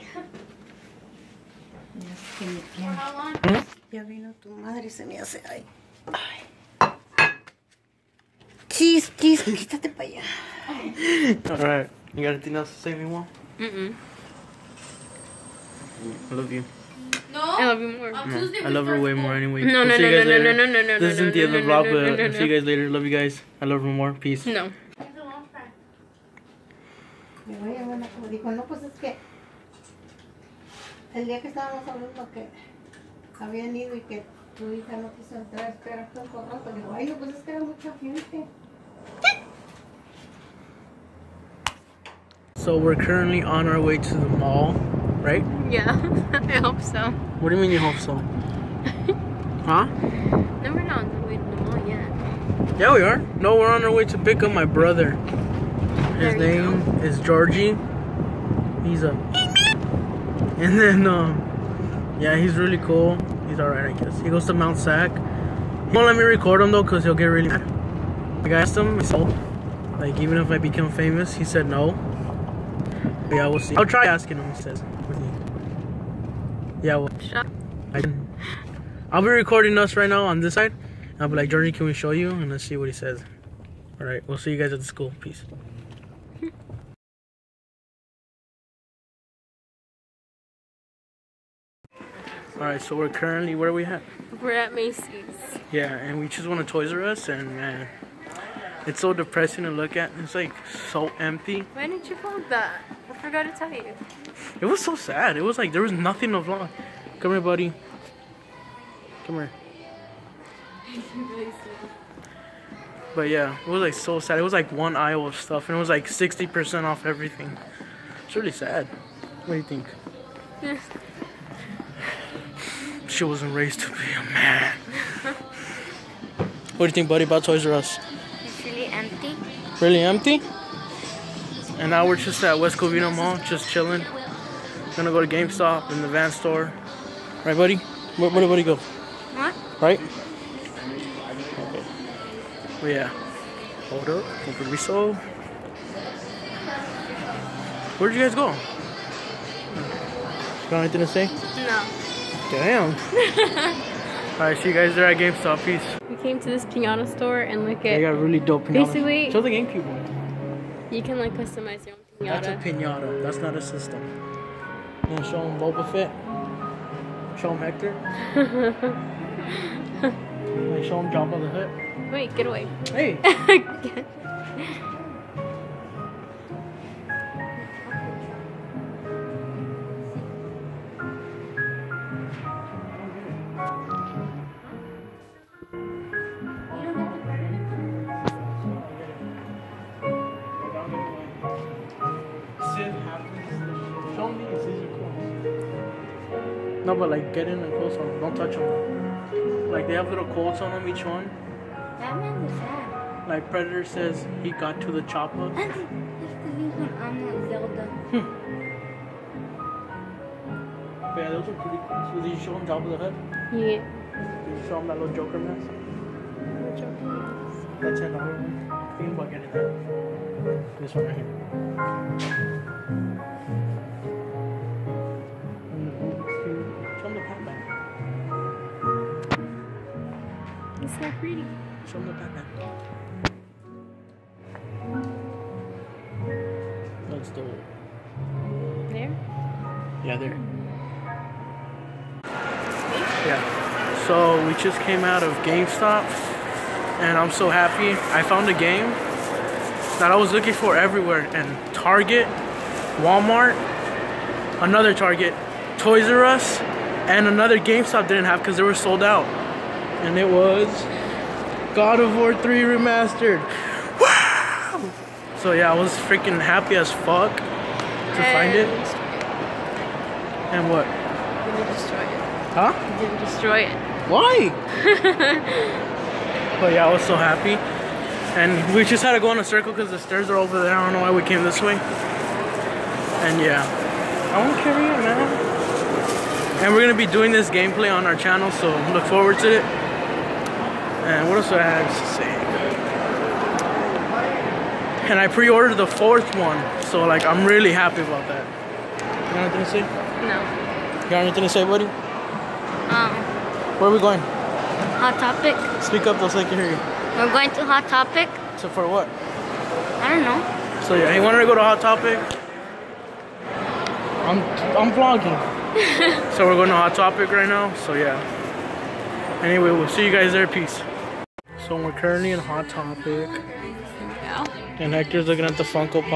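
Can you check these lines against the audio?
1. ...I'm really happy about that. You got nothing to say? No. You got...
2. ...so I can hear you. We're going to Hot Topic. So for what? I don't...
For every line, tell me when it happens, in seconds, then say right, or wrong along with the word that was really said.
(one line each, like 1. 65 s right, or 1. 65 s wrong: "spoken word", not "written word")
1. 297 s wrong: "anything", not "nothing"
2. 306 s right.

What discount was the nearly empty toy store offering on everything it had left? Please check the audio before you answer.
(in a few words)
60% off.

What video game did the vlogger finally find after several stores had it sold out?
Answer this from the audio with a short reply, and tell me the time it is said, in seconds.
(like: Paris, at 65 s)
God of War 3 Remastered, at 261 s.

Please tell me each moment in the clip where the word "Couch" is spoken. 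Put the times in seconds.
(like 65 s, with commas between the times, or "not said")
not said.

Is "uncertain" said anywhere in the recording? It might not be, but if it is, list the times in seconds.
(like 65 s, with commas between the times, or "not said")
not said.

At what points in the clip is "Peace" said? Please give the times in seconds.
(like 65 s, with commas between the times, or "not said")
24 s, 85 s, 155 s, 320 s.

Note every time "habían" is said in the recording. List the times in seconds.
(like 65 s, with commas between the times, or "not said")
33 s.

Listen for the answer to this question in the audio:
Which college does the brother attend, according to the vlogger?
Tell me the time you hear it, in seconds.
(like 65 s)
64 s.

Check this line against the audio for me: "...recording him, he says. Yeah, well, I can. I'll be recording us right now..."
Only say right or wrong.
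wrong.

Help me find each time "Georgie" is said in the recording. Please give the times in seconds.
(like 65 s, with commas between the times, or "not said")
57 s, 81 s.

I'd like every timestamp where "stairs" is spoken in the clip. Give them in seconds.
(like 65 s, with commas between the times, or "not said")
279 s.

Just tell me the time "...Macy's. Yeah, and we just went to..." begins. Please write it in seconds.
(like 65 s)
94 s.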